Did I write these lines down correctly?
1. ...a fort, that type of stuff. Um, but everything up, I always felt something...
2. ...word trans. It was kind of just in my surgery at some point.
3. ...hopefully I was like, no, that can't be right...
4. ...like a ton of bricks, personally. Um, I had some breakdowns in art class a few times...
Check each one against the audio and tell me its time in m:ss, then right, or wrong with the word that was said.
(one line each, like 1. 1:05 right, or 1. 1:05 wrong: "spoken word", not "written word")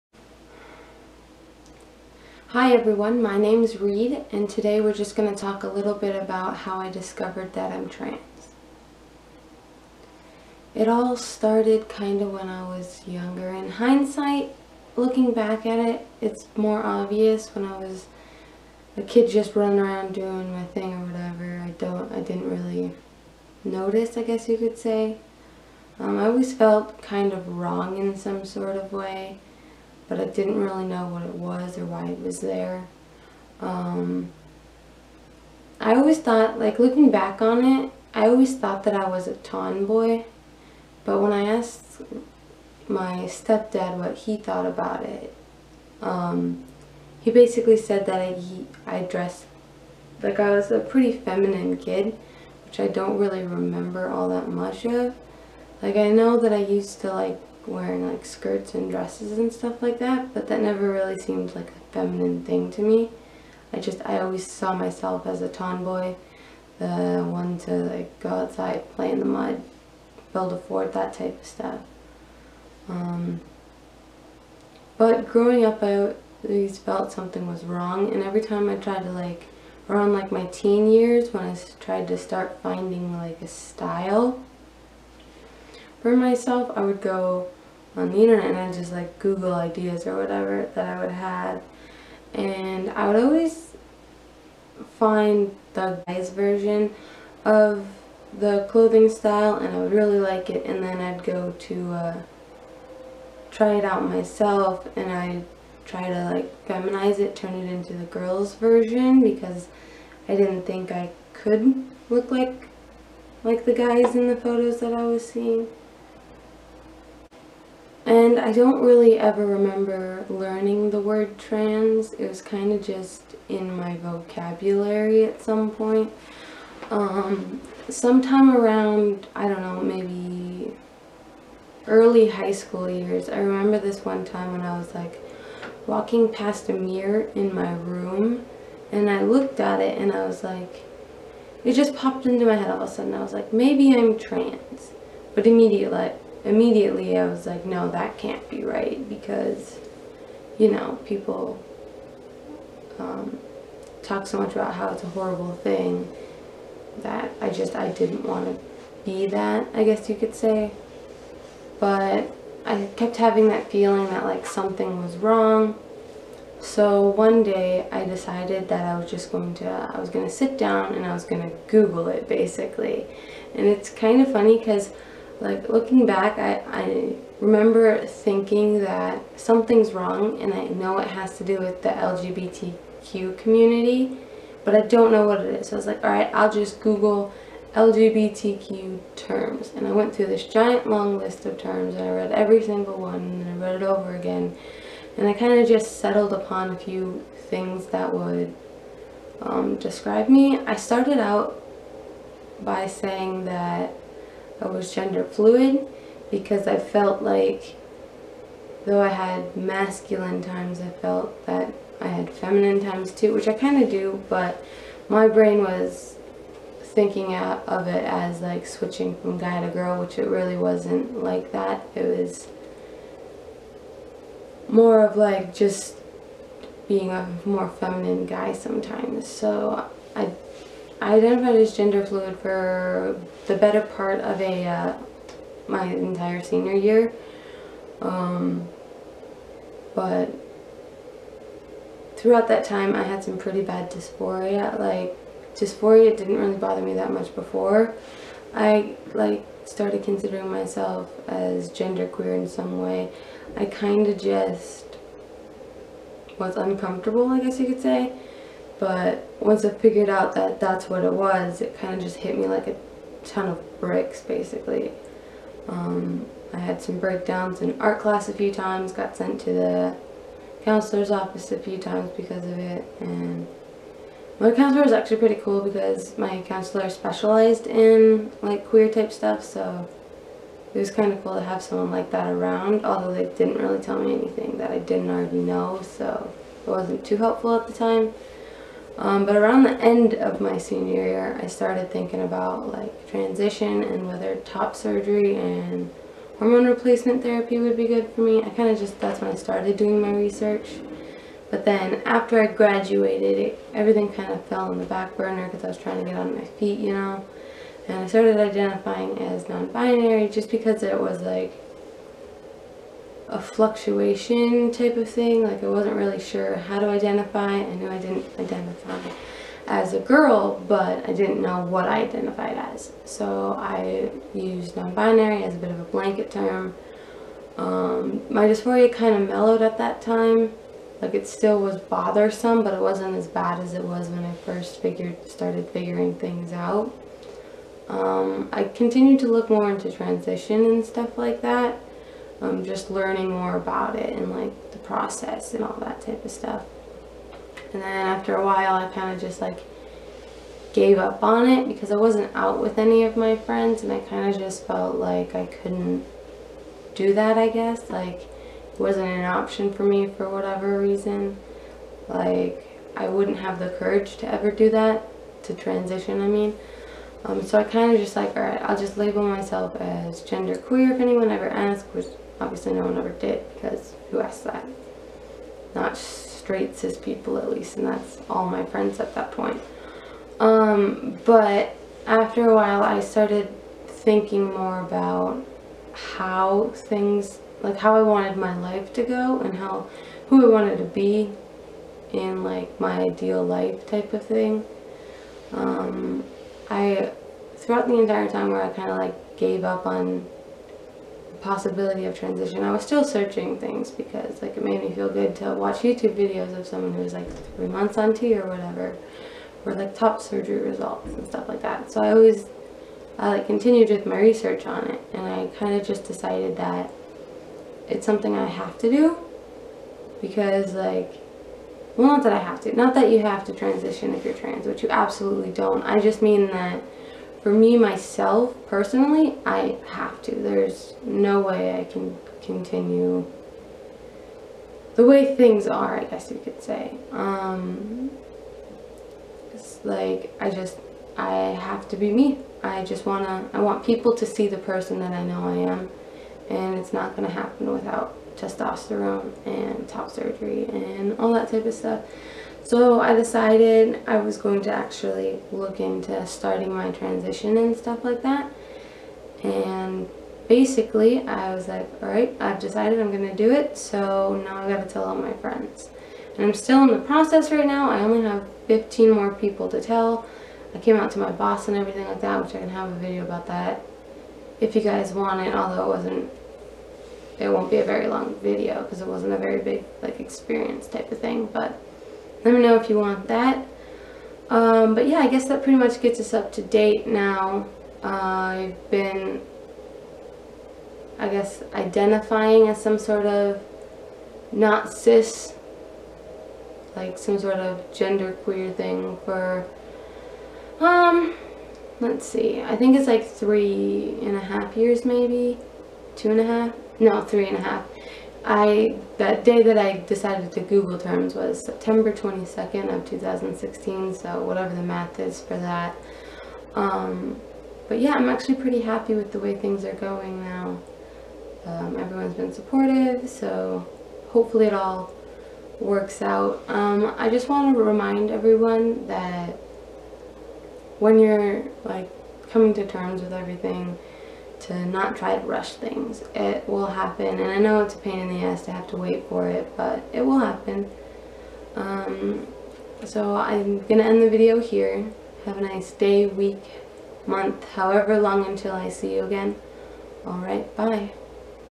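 1. 1:10 wrong: "growing", not "everything"
2. 2:00 wrong: "vocabulary", not "surgery"
3. 2:26 wrong: "immediately", not "hopefully"
4. 4:22 wrong: "basically", not "personally".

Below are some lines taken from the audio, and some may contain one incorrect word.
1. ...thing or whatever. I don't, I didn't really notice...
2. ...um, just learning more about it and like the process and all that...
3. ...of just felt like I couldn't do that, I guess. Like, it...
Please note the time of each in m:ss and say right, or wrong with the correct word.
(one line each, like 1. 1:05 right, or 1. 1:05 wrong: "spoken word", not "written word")
1. 0:20 right
2. 5:42 right
3. 5:54 right.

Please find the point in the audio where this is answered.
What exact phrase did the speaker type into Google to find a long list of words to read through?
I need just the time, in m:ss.
3:07.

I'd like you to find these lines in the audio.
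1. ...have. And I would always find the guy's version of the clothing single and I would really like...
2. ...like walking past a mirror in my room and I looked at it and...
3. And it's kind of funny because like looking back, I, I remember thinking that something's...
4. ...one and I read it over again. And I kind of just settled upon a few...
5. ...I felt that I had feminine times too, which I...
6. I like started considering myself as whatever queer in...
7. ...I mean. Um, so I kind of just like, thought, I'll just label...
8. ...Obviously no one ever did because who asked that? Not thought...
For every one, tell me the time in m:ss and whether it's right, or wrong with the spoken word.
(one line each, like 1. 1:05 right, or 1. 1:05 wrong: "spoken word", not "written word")
1. 1:31 wrong: "style", not "single"
2. 2:14 right
3. 2:53 right
4. 3:13 right
5. 3:30 right
6. 4:08 wrong: "gender", not "whatever"
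7. 6:06 wrong: "alright", not "thought"
8. 6:12 wrong: "straight", not "thought".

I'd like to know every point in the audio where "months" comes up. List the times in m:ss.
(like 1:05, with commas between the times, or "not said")
6:47, 9:07.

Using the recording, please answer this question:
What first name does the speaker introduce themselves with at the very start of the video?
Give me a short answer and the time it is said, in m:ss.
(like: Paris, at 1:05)
Reid, at 0:03.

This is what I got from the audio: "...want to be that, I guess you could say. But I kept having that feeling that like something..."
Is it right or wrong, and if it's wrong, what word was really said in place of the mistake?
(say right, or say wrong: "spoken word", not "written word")
right.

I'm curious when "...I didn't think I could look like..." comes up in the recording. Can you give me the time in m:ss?
1:50.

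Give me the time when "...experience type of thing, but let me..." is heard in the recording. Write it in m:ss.
8:00.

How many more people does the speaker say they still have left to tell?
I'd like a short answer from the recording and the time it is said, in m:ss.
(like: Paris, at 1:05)
15, at 7:48.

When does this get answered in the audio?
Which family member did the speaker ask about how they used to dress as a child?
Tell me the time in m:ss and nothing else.
0:43.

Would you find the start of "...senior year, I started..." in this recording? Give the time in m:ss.
4:50.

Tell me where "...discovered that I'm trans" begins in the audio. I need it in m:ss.
0:06.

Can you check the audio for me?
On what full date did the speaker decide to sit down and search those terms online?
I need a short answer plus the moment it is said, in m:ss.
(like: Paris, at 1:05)
September 22, 2016, at 8:31.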